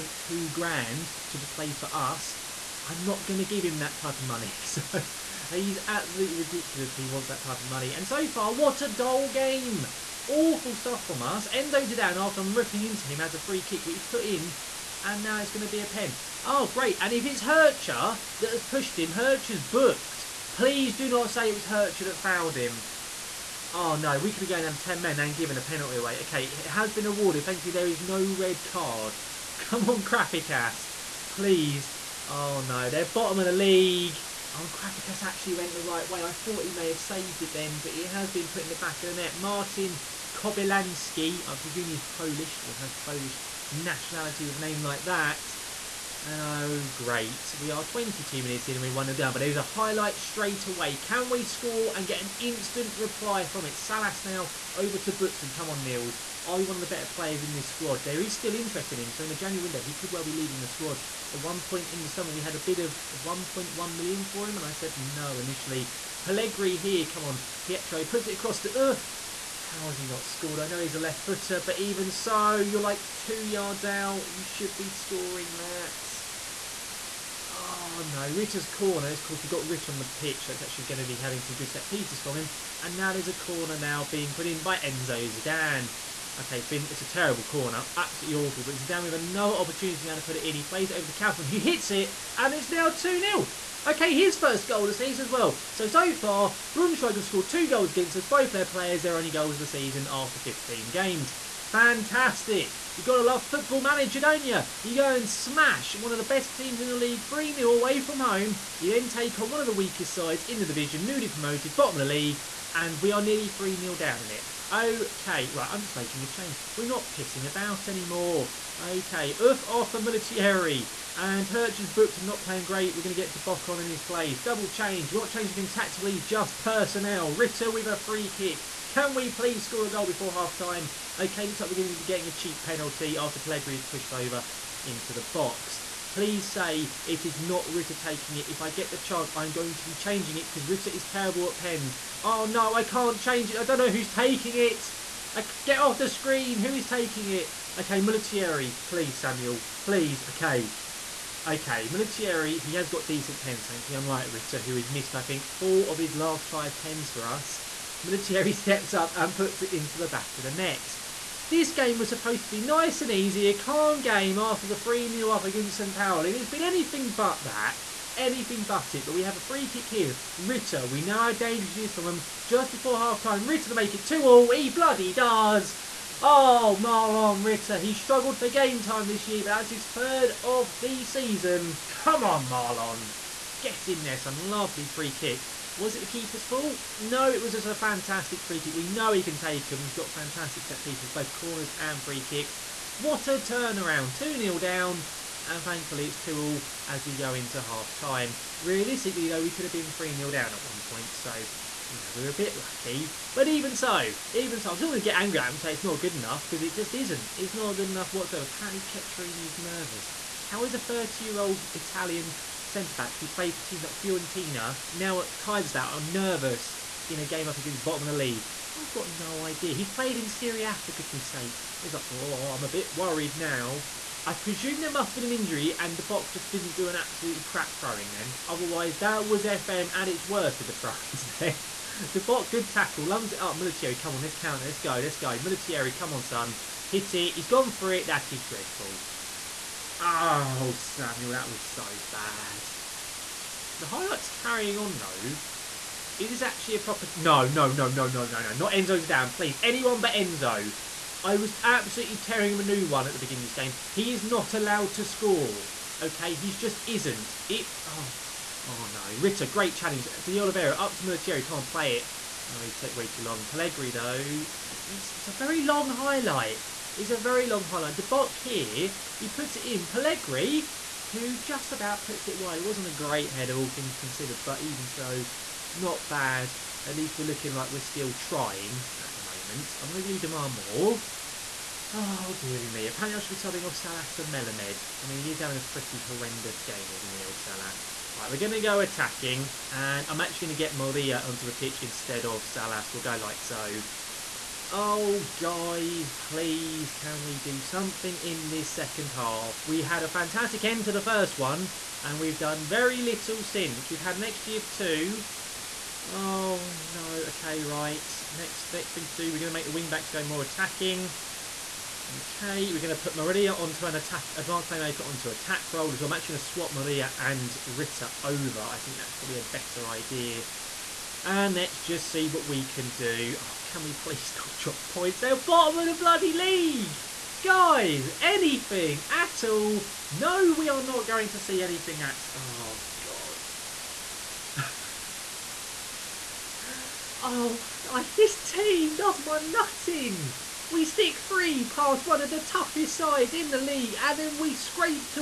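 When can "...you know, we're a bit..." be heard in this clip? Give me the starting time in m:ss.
3:21.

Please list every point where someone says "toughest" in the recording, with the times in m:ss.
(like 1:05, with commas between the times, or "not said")
5:42.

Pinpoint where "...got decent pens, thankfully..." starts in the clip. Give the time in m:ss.
2:32.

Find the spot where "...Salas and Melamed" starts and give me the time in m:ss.
4:43.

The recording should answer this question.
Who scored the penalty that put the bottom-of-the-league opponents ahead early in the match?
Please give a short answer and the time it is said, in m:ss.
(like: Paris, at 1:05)
Martin Kobylanski, at 0:39.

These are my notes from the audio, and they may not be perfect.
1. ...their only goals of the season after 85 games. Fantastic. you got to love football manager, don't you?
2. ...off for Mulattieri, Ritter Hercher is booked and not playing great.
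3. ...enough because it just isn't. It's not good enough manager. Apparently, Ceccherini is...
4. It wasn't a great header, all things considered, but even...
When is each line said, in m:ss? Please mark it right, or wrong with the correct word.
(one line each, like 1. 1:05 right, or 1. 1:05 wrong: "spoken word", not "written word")
1. 1:39 wrong: "15", not "85"
2. 1:59 wrong: "And", not "Ritter"
3. 3:26 wrong: "whatsoever", not "manager"
4. 4:32 right.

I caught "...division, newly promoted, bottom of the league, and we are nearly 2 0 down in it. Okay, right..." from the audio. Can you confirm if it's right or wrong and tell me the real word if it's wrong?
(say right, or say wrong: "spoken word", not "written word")
wrong: "3", not "2".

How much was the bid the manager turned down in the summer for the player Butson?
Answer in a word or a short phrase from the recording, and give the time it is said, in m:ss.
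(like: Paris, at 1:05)
1.1 million, at 1:03.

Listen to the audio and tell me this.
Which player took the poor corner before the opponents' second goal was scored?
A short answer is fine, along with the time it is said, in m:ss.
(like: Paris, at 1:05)
Enzo Zidane, at 1:24.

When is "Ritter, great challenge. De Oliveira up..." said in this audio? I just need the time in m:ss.
4:19.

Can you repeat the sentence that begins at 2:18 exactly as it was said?
If I get the chance, I'm going to be changing it because Ritter is terrible at pens.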